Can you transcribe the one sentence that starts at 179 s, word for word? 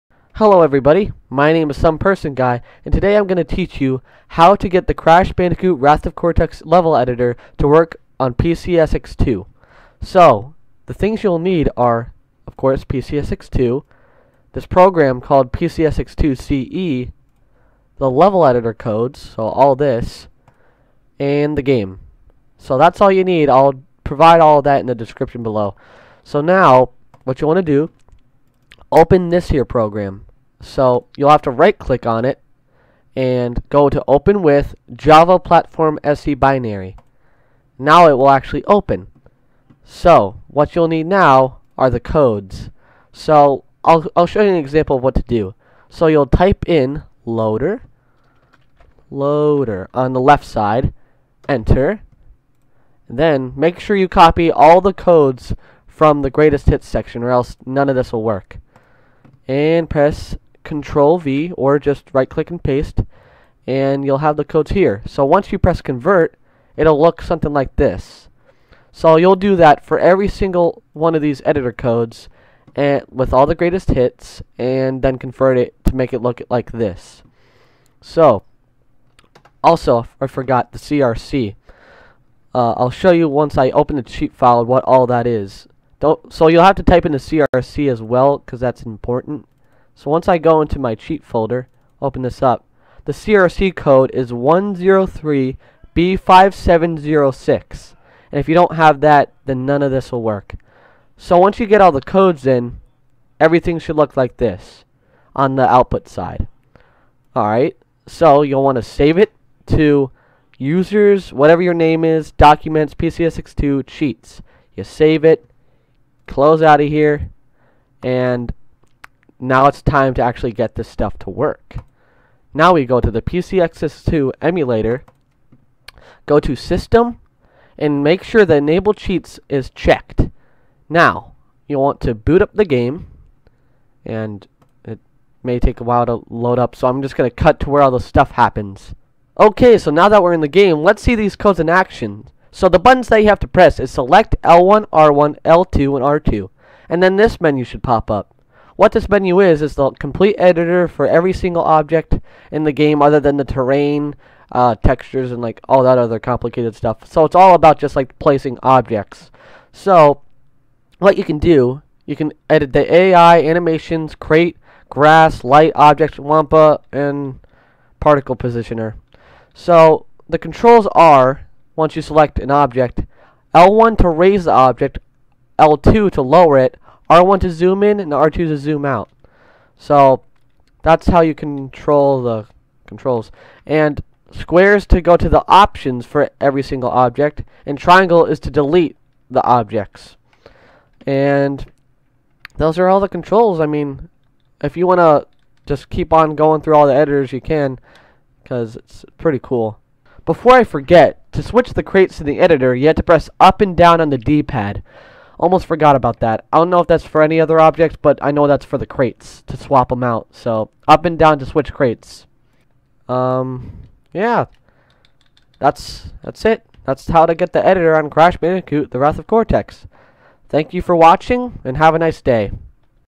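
So that's how you control the controls.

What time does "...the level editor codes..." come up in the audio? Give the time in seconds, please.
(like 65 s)
17 s.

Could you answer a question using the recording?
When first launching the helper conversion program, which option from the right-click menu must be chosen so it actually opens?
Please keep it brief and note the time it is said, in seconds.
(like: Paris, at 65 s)
Java Platform SE Binary, at 34 s.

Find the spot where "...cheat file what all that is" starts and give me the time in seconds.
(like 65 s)
84 s.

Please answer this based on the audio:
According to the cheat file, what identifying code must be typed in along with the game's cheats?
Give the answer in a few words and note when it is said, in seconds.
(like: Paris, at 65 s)
103B5706, at 94 s.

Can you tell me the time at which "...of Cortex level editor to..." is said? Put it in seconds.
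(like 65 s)
6 s.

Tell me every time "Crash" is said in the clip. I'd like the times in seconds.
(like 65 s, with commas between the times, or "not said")
4 s, 218 s.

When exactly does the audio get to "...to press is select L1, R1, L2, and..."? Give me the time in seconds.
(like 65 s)
143 s.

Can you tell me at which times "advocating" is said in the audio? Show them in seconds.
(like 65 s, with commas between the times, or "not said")
not said.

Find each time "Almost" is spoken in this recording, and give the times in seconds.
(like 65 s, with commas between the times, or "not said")
205 s.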